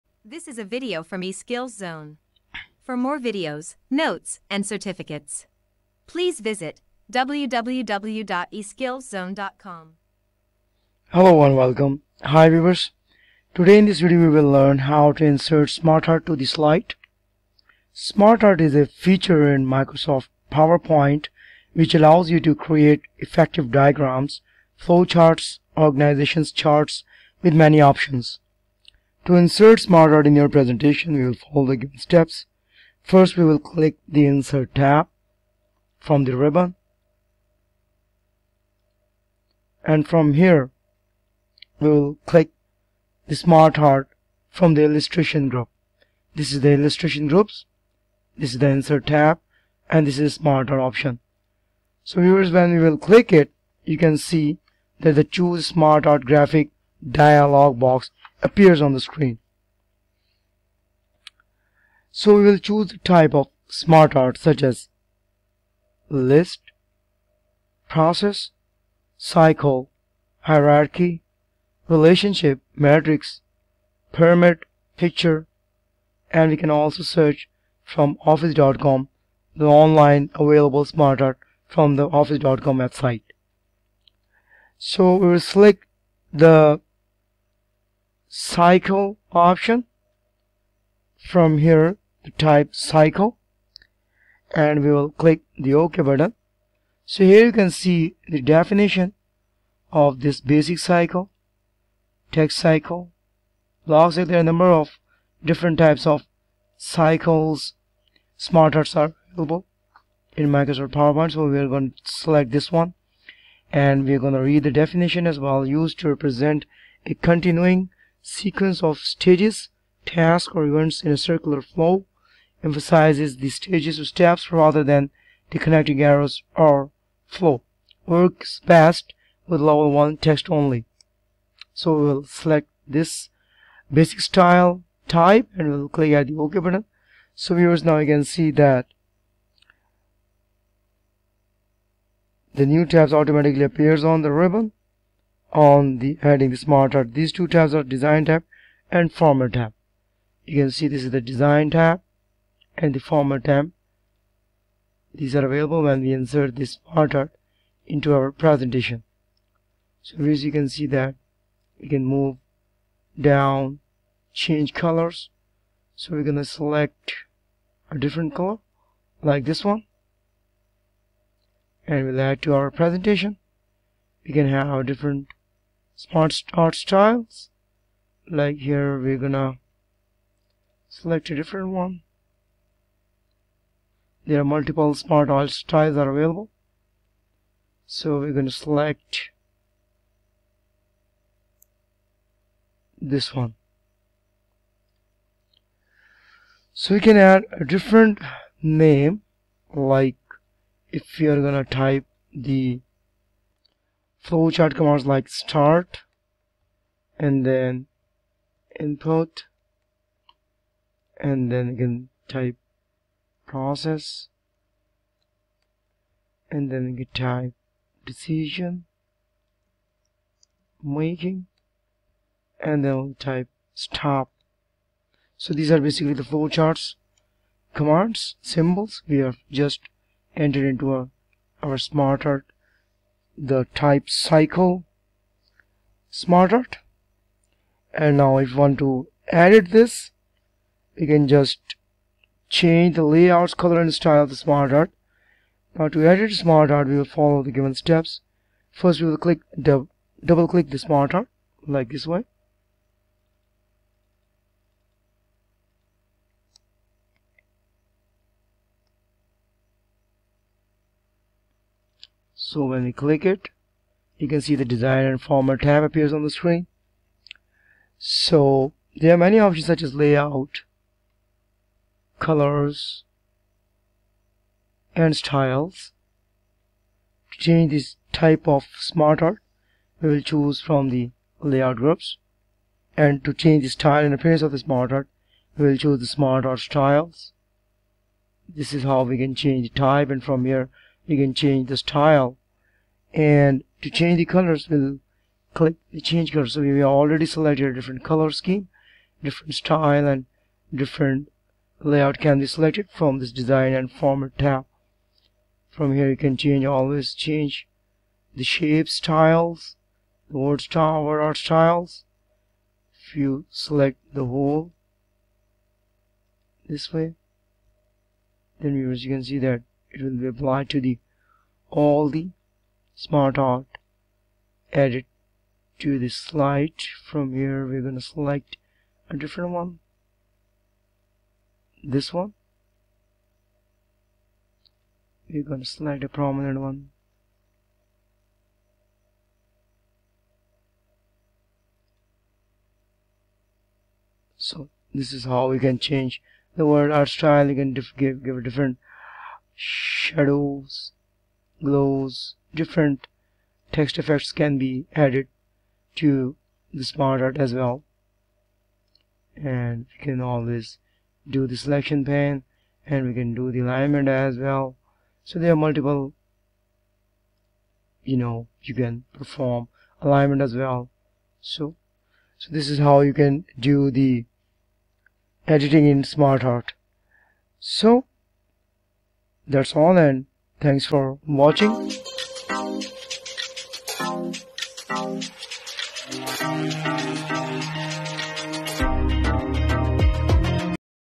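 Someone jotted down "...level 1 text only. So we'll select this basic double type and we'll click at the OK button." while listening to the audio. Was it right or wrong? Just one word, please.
wrong.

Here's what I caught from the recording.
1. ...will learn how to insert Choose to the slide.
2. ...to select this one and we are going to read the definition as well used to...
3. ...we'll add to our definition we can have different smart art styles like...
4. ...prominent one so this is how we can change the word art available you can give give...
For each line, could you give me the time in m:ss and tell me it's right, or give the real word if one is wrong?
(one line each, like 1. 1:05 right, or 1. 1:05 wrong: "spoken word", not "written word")
1. 0:14 wrong: "SmartArt", not "Choose"
2. 1:51 right
3. 2:52 wrong: "presentation", not "definition"
4. 5:36 wrong: "style", not "available".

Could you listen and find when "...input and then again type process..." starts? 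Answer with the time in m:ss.
3:28.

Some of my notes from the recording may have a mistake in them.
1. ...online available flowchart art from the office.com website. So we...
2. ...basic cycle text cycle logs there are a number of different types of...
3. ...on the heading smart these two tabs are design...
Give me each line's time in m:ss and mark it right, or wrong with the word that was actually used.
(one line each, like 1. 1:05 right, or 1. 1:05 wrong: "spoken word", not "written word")
1. 1:19 wrong: "smart", not "flowchart"
2. 1:40 right
3. 2:25 right.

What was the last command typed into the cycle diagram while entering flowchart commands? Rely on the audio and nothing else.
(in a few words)
Stop.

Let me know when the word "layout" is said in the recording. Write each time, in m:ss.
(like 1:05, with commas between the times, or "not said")
4:03, 4:29, 4:41, 5:01.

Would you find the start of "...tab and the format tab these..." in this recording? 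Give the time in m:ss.
2:31.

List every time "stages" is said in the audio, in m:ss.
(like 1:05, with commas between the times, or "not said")
1:58, 2:03.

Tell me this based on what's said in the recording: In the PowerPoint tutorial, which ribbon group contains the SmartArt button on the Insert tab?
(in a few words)
Illustration group.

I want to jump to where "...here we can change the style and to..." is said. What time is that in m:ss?
4:50.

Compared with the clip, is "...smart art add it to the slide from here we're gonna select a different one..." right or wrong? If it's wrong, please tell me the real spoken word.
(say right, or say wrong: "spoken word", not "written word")
right.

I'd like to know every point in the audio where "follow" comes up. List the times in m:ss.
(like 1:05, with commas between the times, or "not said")
0:31, 4:07.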